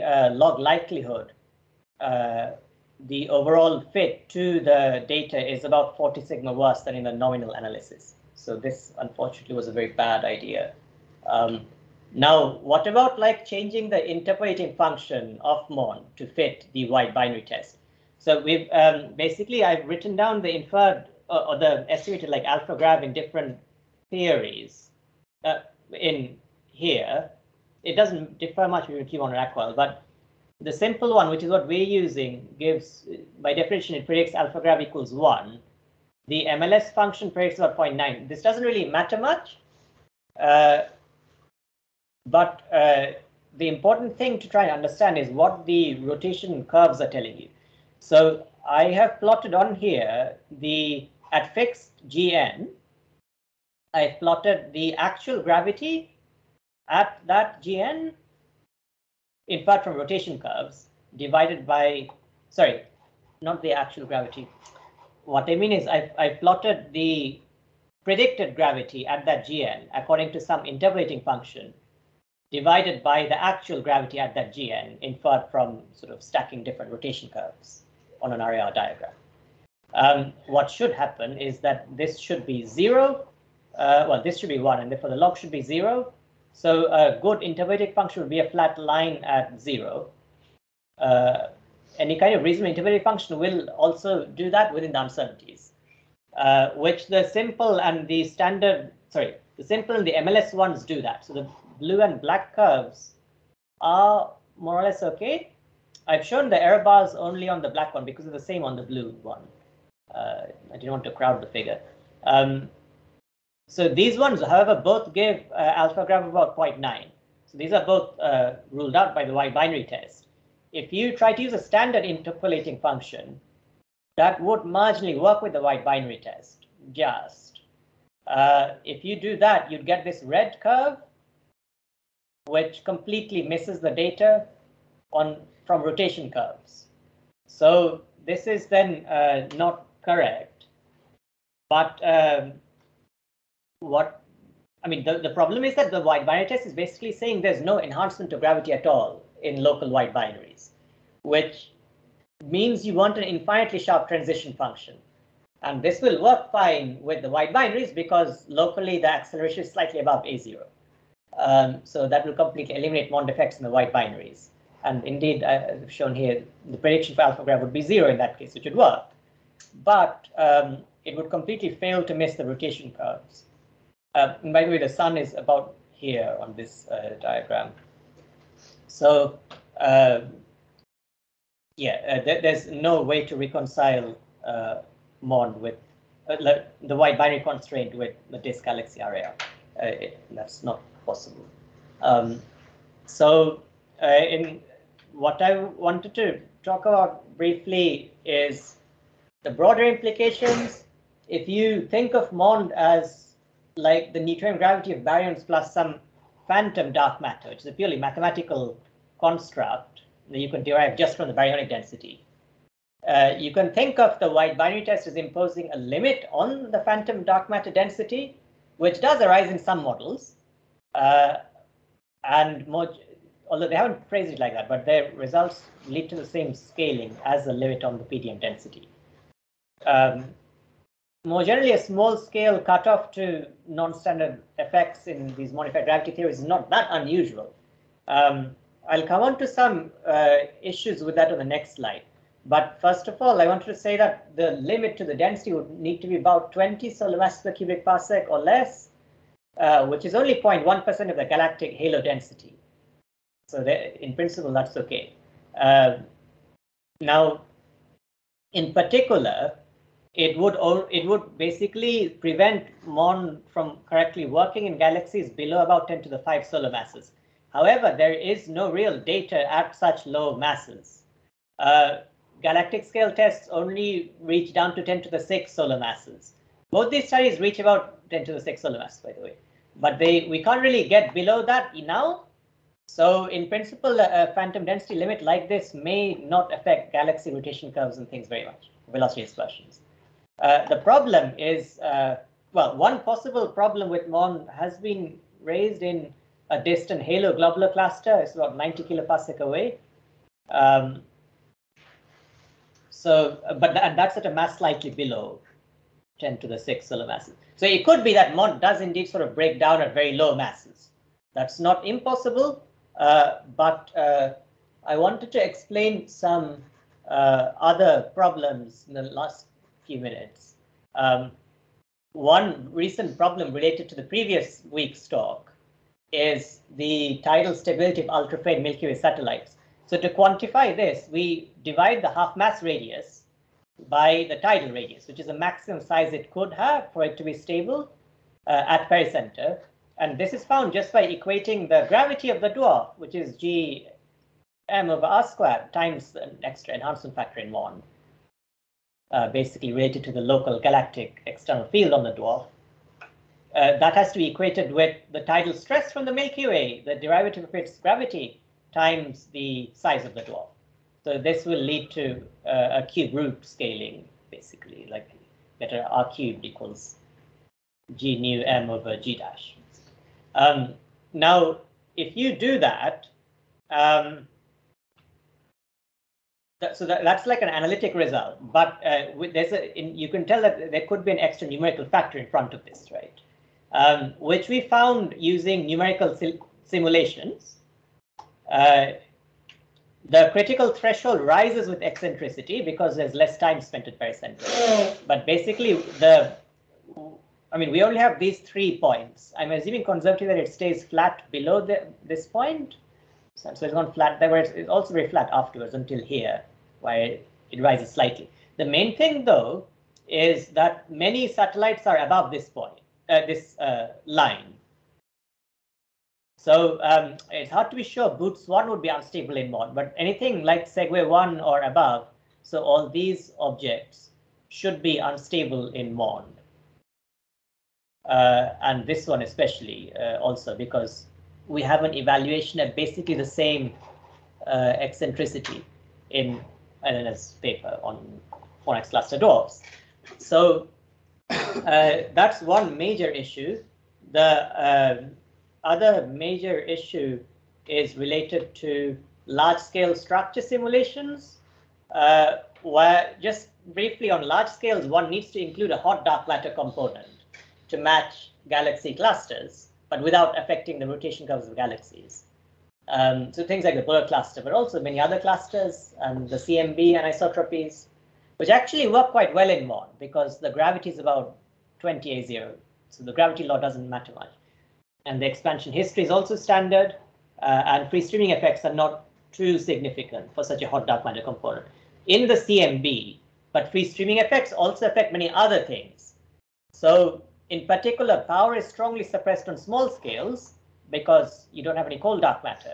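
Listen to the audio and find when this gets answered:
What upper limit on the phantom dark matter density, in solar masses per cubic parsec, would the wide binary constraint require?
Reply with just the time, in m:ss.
4:06.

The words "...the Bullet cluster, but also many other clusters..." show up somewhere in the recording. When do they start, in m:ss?
7:43.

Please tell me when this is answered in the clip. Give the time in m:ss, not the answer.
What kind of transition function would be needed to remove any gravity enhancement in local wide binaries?
2:33.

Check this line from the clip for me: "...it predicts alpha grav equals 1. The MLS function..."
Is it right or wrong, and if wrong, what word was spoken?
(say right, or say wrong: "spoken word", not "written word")
right.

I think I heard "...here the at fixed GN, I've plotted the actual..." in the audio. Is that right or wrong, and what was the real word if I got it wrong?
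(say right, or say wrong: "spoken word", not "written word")
right.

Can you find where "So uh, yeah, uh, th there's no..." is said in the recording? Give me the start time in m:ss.
2:58.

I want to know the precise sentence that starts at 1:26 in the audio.
So a uh, good intermediate function would be a flat line at zero.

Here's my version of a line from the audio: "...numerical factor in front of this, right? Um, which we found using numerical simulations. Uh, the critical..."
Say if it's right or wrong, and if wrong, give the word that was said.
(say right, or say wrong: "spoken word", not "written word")
right.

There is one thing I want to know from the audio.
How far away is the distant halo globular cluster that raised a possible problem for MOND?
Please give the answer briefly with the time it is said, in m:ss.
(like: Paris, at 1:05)
90 kiloparsecs, at 4:58.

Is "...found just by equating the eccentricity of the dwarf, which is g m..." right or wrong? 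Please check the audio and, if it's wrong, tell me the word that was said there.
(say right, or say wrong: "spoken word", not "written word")
wrong: "gravity", not "eccentricity".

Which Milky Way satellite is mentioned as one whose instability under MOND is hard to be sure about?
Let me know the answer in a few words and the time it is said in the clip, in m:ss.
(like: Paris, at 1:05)
Boötes 1, at 6:58.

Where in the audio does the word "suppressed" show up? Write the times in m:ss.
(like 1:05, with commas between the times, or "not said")
8:09.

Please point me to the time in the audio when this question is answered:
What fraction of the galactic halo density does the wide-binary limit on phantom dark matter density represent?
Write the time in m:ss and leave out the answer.
4:10.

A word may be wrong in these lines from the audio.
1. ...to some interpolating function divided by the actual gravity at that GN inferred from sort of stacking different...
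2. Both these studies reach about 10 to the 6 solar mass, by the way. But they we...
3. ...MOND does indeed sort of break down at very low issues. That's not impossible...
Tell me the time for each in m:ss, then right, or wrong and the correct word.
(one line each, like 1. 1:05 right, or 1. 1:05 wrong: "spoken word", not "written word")
1. 1:10 right
2. 4:36 right
3. 5:08 wrong: "masses", not "issues".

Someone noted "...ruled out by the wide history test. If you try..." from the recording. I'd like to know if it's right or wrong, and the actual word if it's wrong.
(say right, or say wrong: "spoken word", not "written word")
wrong: "binary", not "history".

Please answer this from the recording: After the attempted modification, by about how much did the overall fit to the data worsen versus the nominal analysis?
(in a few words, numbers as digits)
40 sigma.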